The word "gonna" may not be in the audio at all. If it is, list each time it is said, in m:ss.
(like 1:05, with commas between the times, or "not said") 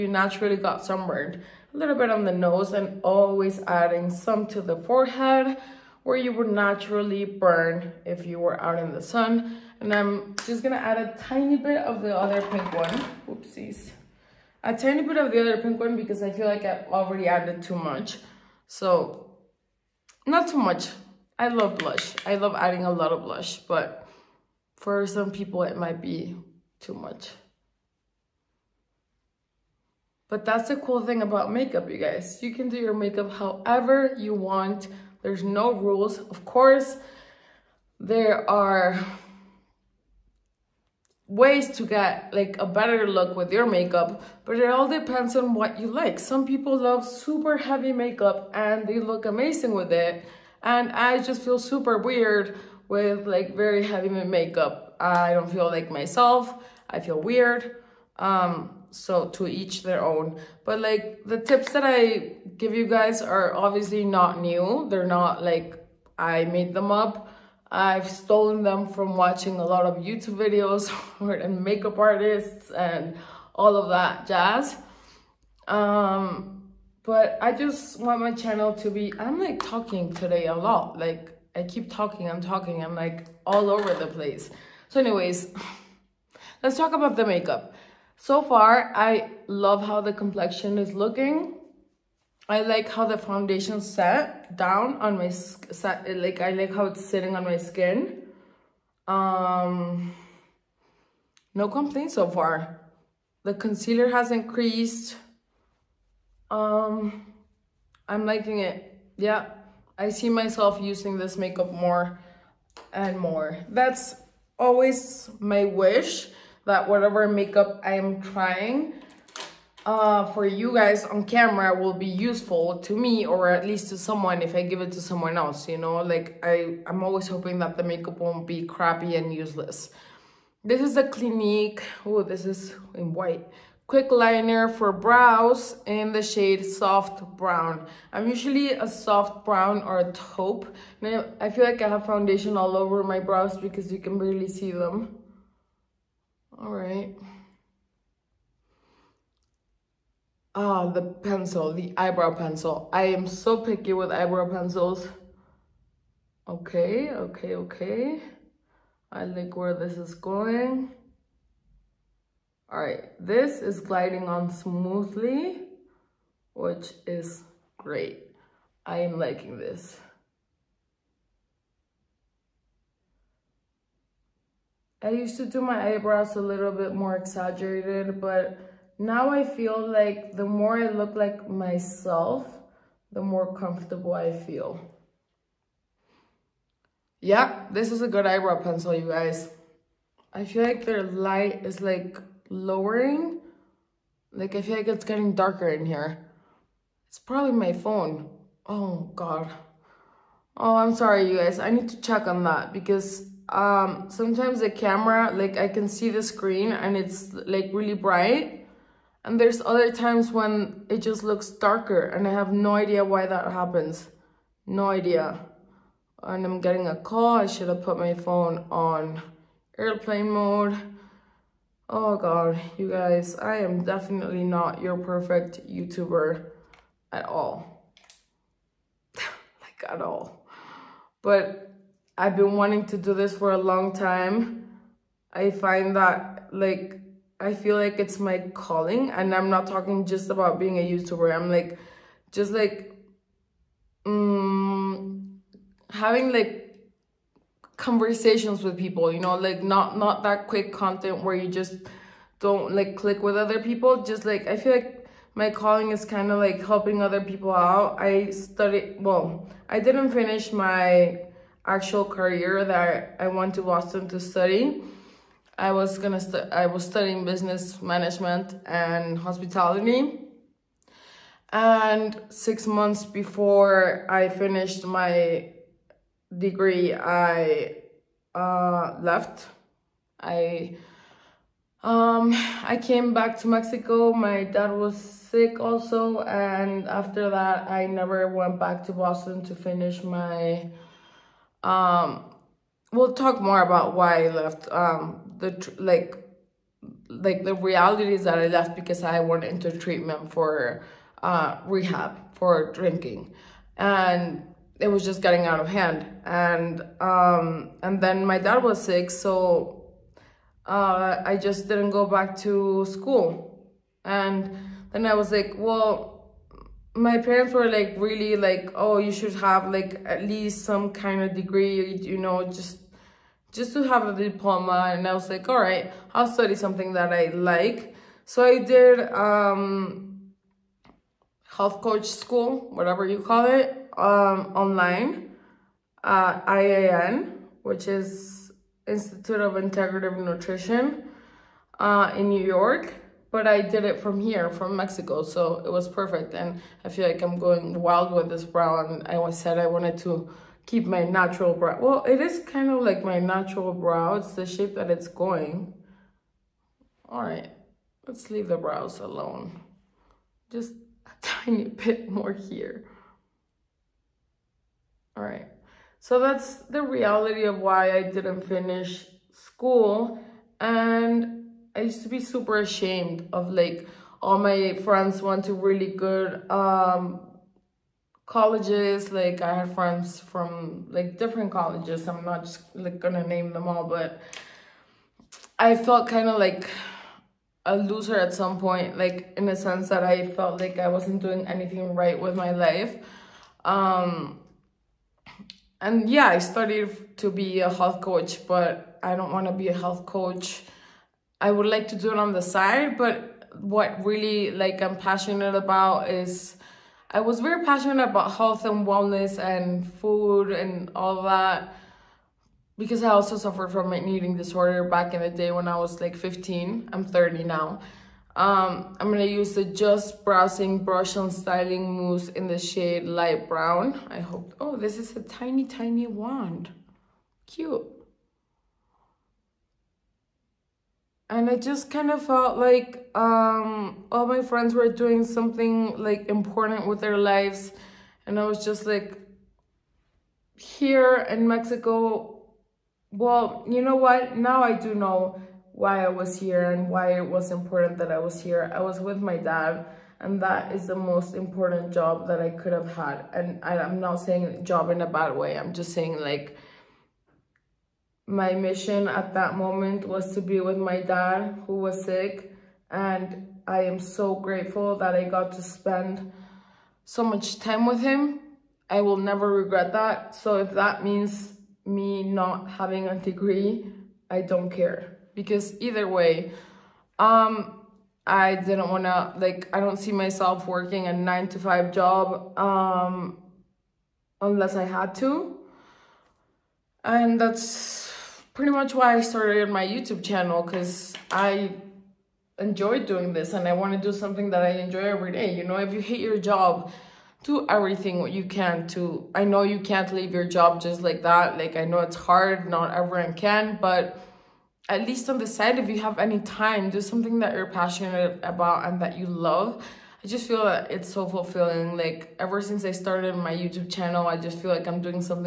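0:10, 4:25, 6:22, 6:59.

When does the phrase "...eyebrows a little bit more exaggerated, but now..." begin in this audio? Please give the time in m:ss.
2:55.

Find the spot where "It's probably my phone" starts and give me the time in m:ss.
3:17.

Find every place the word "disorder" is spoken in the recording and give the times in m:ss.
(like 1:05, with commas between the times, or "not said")
6:54.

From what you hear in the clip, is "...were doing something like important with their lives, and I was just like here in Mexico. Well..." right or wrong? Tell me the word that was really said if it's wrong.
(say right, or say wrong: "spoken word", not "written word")
right.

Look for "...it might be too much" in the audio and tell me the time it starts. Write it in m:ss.
0:25.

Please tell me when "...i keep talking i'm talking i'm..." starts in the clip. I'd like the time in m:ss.
1:21.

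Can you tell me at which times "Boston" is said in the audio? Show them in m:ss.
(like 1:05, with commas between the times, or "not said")
4:23, 4:48.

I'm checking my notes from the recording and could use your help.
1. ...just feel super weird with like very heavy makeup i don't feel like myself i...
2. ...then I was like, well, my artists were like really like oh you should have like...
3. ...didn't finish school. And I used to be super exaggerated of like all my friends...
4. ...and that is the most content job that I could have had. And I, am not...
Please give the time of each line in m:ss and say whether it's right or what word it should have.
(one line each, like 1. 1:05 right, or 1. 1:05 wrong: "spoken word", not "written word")
1. 0:51 right
2. 5:14 wrong: "parents", not "artists"
3. 6:08 wrong: "ashamed", not "exaggerated"
4. 7:30 wrong: "important", not "content".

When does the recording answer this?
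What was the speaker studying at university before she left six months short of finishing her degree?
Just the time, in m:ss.
4:27.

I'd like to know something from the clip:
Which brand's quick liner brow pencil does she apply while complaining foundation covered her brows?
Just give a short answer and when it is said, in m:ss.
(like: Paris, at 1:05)
Clinique, at 2:11.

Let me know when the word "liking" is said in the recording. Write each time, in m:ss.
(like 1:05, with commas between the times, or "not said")
1:48, 2:49.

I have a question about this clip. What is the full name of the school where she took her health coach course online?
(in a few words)
Institute of Integrative Nutrition.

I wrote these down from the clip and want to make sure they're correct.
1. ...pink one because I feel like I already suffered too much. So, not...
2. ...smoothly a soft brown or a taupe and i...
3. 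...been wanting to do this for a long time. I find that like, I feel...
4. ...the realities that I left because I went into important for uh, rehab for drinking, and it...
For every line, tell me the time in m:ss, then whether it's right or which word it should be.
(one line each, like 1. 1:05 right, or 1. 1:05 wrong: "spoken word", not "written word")
1. 0:15 wrong: "added", not "suffered"
2. 2:18 wrong: "usually", not "smoothly"
3. 3:52 right
4. 4:57 wrong: "treatment", not "important".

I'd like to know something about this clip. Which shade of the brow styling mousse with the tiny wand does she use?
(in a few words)
Light Brown.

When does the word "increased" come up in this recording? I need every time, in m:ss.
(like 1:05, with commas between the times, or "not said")
1:44.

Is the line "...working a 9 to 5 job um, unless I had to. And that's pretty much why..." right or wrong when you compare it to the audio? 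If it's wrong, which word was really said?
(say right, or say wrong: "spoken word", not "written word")
right.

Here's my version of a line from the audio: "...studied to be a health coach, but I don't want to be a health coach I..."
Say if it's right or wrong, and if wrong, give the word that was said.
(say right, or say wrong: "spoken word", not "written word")
right.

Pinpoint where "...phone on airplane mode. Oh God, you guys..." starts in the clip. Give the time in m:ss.
3:38.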